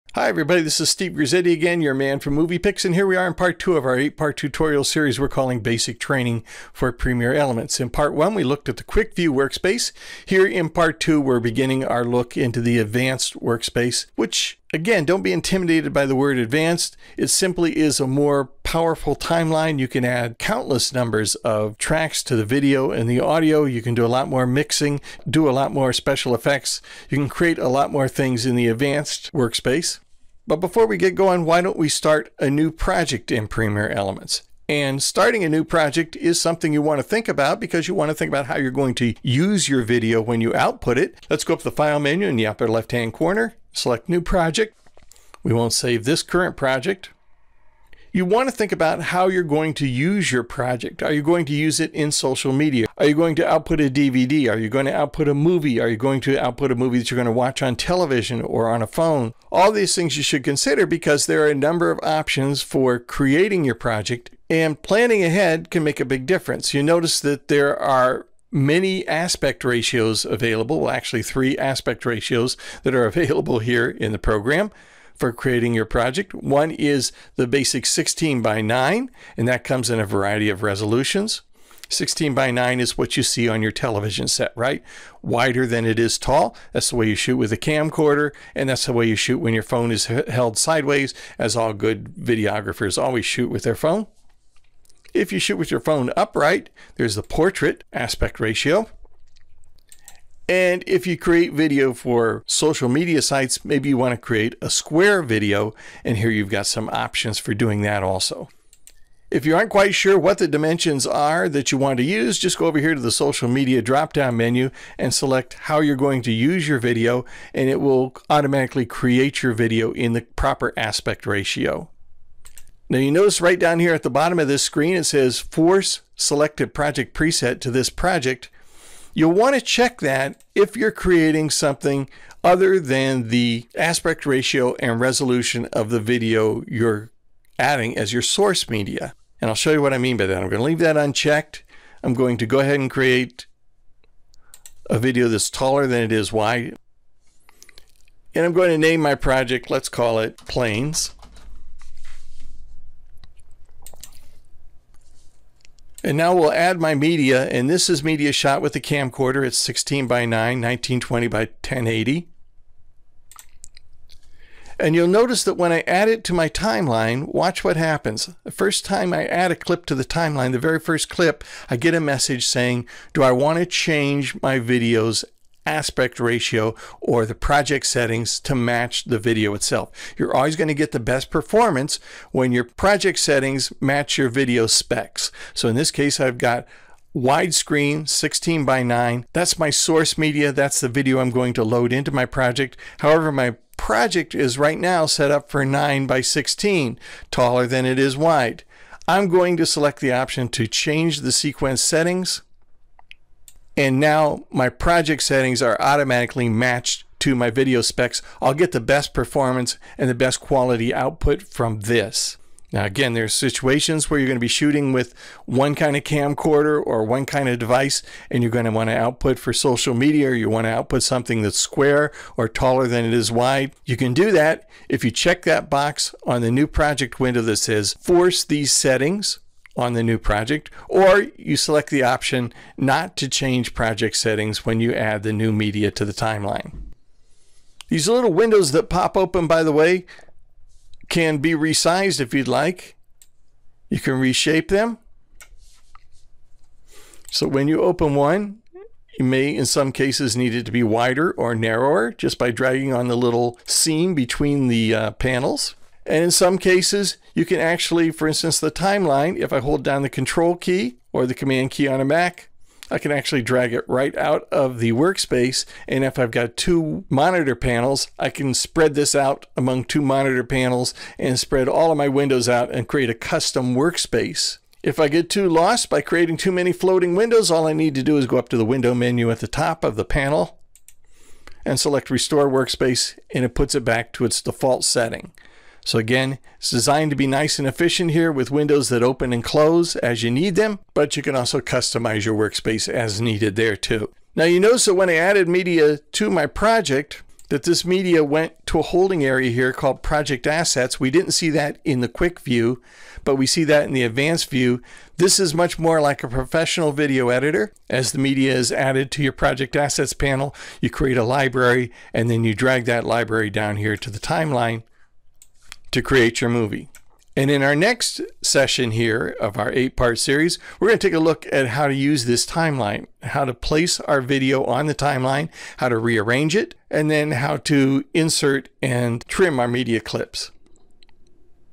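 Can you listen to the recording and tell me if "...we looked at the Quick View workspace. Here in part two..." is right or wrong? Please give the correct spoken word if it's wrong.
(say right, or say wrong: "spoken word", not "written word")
right.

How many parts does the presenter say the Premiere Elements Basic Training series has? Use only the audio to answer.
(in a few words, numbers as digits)
8.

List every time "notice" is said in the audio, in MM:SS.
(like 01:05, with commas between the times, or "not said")
01:06, 02:03, 02:45, 04:54.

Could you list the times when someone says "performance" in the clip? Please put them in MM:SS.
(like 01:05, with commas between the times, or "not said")
03:01, 03:29.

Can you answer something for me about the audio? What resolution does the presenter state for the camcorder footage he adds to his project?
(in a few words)
1920 by 1080.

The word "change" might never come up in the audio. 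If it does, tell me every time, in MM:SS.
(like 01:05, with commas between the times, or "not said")
02:53, 03:20, 03:53.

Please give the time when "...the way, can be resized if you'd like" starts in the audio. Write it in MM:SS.
03:59.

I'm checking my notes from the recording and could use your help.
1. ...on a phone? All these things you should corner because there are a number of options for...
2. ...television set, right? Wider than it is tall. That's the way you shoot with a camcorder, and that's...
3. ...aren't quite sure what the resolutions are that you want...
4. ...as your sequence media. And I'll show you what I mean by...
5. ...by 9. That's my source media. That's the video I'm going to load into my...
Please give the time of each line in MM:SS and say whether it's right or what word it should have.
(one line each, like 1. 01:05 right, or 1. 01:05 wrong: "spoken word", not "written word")
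1. 00:58 wrong: "consider", not "corner"
2. 01:23 right
3. 01:49 wrong: "dimensions", not "resolutions"
4. 02:17 wrong: "source", not "sequence"
5. 03:08 right.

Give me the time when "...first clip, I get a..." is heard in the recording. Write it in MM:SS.
02:50.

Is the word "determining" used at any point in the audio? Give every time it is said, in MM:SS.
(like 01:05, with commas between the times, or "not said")
not said.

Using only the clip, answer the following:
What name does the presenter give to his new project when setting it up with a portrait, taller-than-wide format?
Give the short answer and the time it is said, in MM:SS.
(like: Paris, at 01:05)
planes, at 02:30.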